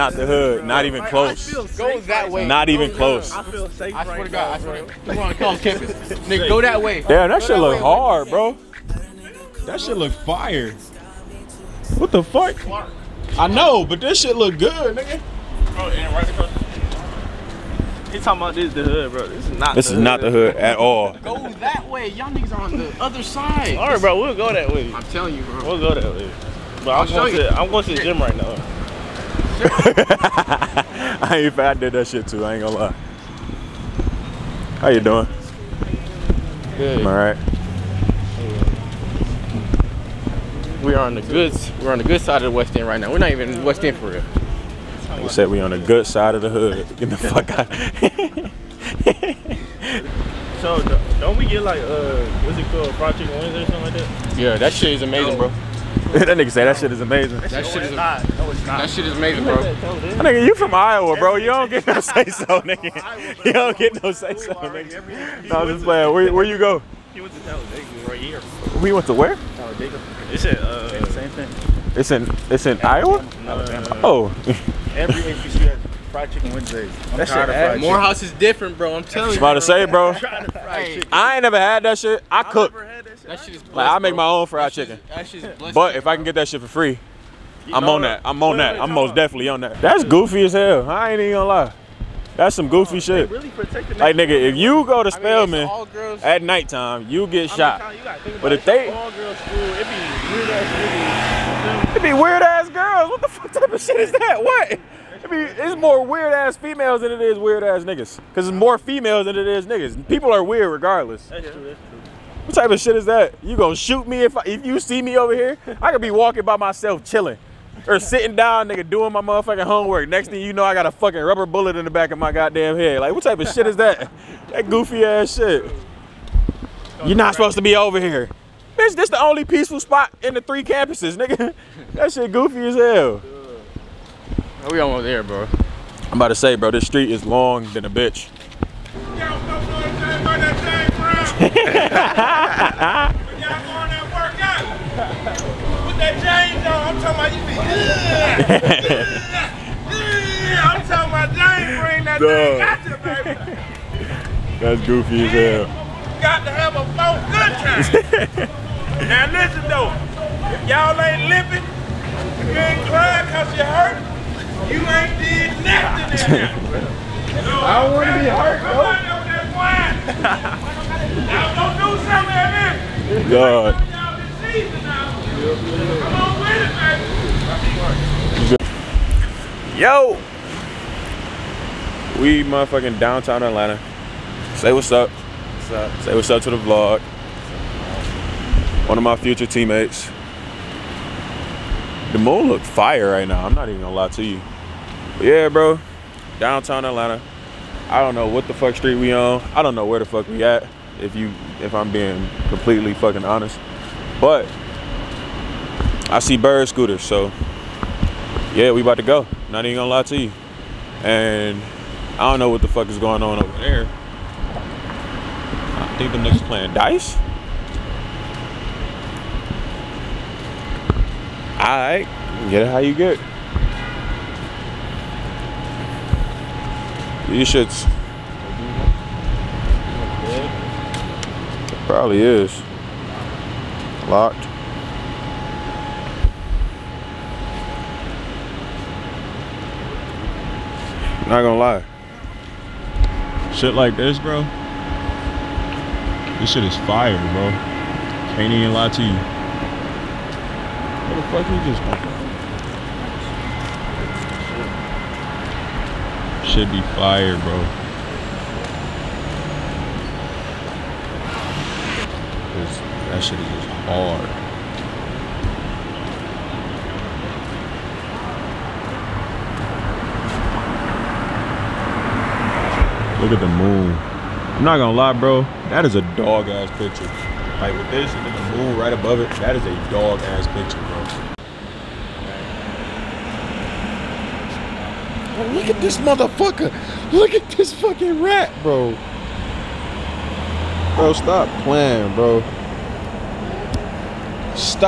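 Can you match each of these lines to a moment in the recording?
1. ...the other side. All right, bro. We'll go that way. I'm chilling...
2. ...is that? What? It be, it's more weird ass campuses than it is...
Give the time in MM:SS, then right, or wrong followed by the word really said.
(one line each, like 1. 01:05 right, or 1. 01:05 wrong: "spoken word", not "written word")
1. 00:22 wrong: "telling", not "chilling"
2. 01:43 wrong: "females", not "campuses".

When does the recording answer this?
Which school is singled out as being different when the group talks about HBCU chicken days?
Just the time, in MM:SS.
01:17.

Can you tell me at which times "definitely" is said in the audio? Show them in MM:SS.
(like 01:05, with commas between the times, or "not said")
01:29.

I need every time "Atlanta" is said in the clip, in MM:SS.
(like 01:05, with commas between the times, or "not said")
03:03, 03:16.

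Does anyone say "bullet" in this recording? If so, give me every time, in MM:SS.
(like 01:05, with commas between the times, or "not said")
02:01.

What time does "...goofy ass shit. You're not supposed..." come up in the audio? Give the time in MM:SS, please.
02:04.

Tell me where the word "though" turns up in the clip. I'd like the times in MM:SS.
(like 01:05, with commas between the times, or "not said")
02:39, 02:48.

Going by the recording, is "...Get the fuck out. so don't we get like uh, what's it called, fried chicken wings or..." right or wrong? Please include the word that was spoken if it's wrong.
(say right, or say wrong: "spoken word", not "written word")
right.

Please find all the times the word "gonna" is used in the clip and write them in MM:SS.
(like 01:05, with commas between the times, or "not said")
00:32, 01:31, 01:53, 03:13, 03:29, 04:01, 04:34.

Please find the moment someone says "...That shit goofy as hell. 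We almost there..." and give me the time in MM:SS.
02:11.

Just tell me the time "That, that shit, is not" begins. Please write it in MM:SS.
00:57.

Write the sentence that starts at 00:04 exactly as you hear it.
Come on, come on, campus, nigga.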